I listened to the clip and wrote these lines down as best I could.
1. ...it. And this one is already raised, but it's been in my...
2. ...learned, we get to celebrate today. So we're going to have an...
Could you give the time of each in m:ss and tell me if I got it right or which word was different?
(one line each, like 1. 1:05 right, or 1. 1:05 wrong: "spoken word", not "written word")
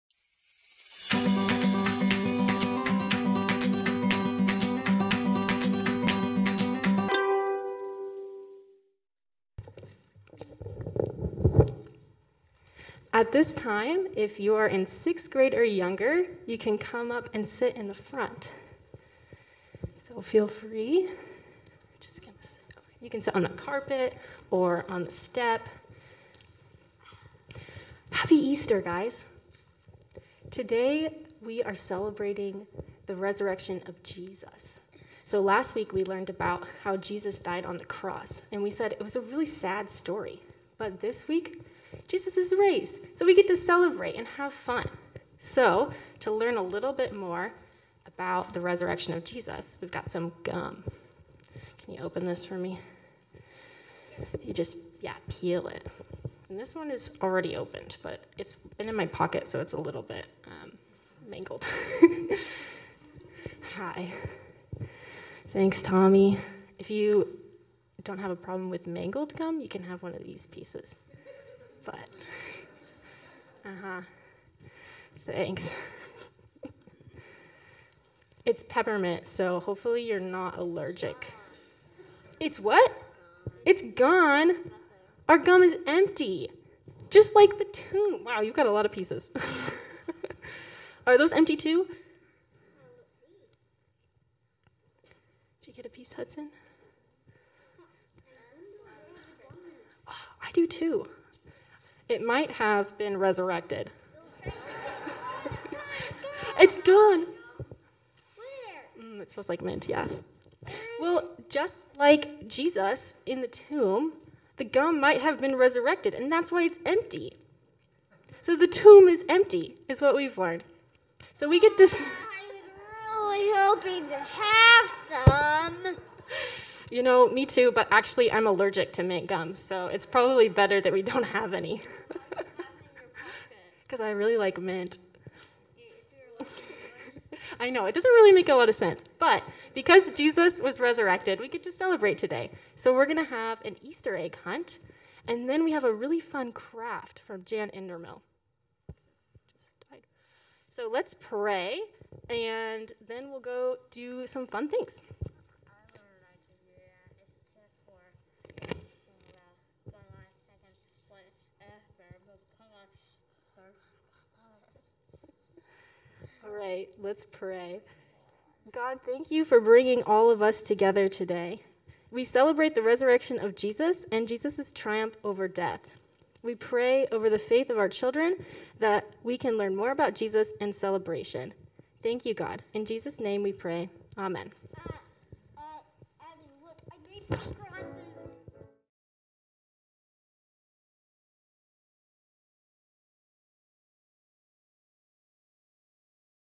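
1. 0:55 wrong: "opened", not "raised"
2. 2:20 wrong: "resurrected", not "learned".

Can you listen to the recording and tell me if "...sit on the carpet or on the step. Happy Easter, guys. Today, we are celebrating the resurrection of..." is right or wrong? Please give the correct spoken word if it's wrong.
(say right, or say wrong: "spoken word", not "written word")
right.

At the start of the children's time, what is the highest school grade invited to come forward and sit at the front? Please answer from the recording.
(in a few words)
sixth grade.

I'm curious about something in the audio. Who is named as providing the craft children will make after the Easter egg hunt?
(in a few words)
Jan Endermill.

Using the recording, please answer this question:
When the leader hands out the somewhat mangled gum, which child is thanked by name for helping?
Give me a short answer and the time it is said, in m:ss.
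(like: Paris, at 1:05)
Tommy, at 1:05.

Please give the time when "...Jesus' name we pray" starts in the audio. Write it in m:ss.
3:02.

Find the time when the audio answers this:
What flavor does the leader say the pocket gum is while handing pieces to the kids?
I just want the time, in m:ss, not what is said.
1:18.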